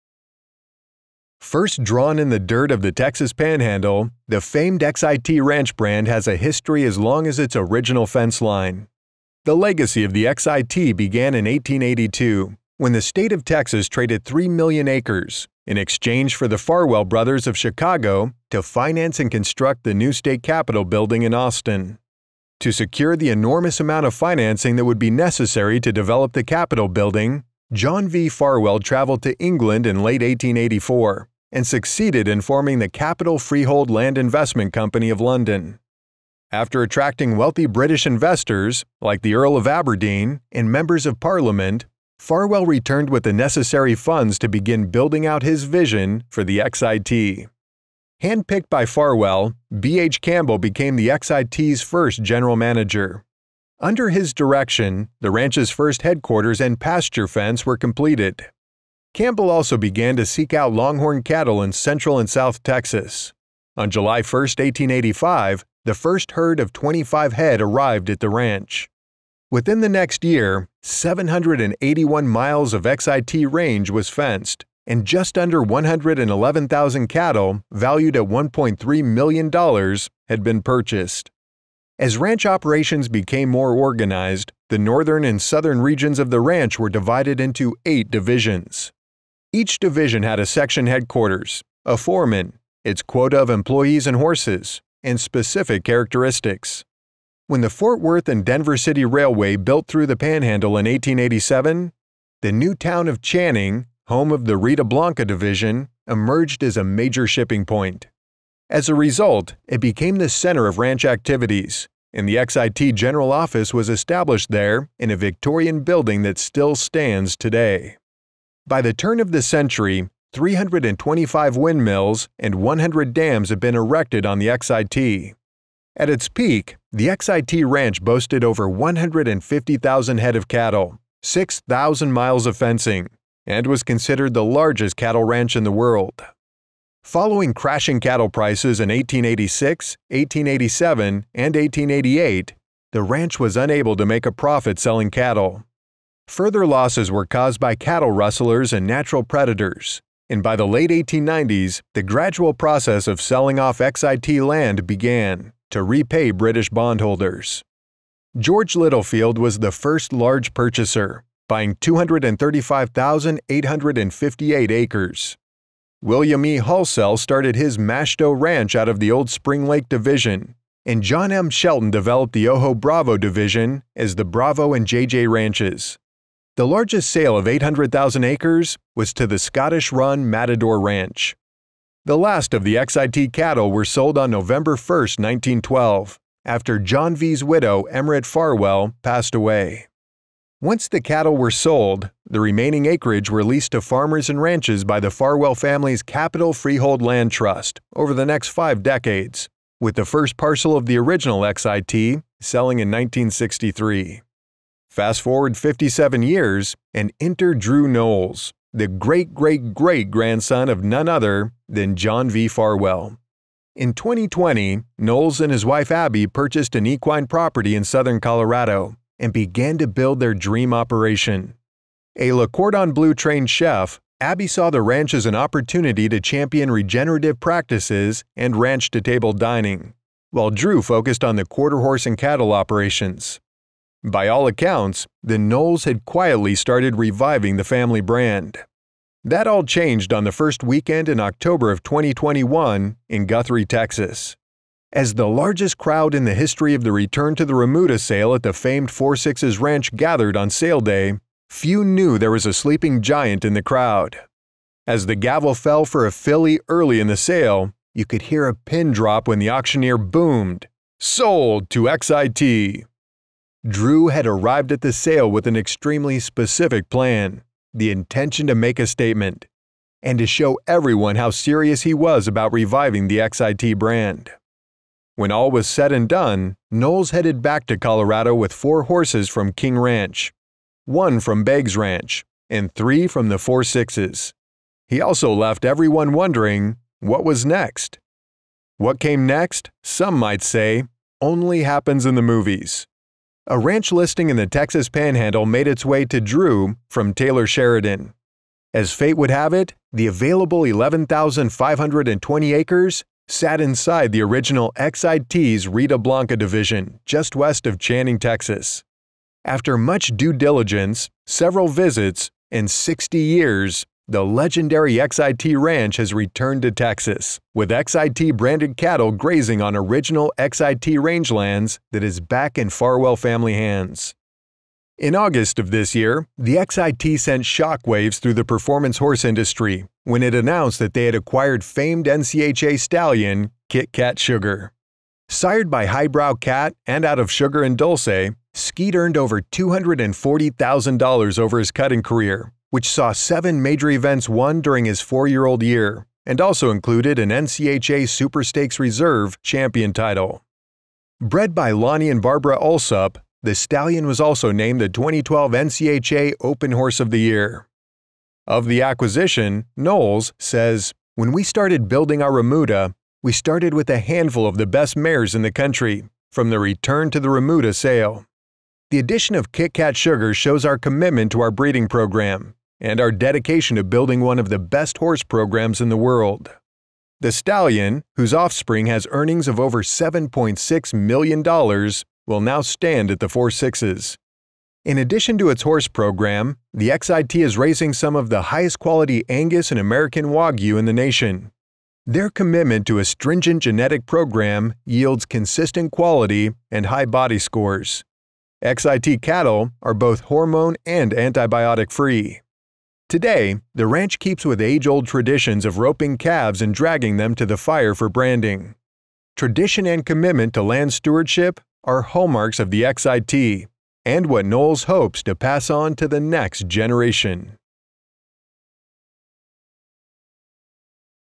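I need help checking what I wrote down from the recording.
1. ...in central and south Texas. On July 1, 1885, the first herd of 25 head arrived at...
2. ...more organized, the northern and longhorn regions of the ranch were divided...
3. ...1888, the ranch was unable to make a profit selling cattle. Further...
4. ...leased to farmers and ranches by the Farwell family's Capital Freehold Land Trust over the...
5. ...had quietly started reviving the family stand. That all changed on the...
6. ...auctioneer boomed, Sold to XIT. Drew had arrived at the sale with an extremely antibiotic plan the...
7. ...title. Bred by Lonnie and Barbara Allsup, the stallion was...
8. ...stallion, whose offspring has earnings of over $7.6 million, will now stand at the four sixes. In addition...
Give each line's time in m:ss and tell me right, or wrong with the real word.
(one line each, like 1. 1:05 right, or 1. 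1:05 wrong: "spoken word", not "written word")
1. 1:01 right
2. 1:23 wrong: "southern", not "longhorn"
3. 2:21 right
4. 3:13 right
5. 3:55 wrong: "brand", not "stand"
6. 4:19 wrong: "specific", not "antibiotic"
7. 5:49 right
8. 6:17 right.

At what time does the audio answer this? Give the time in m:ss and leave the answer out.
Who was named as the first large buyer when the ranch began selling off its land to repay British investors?
2:38.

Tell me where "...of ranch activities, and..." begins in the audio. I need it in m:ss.
1:50.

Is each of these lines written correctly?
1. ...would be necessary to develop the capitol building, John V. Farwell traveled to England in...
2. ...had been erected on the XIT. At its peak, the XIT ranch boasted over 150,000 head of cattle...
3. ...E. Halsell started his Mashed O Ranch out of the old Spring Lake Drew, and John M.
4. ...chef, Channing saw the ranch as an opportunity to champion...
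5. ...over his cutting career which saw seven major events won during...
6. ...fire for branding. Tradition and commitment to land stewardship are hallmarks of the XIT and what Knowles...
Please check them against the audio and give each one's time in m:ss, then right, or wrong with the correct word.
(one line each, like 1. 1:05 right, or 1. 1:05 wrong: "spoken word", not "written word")
1. 0:24 right
2. 2:03 right
3. 2:46 wrong: "Division", not "Drew"
4. 3:43 wrong: "Abby", not "Channing"
5. 5:41 right
6. 6:47 right.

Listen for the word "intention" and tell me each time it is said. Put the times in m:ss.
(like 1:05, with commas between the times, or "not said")
4:27.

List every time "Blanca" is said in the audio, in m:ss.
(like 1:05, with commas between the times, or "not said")
1:44, 5:05.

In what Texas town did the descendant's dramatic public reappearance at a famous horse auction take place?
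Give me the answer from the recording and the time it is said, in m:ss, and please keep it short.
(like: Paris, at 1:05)
Guthrie, Texas, at 4:03.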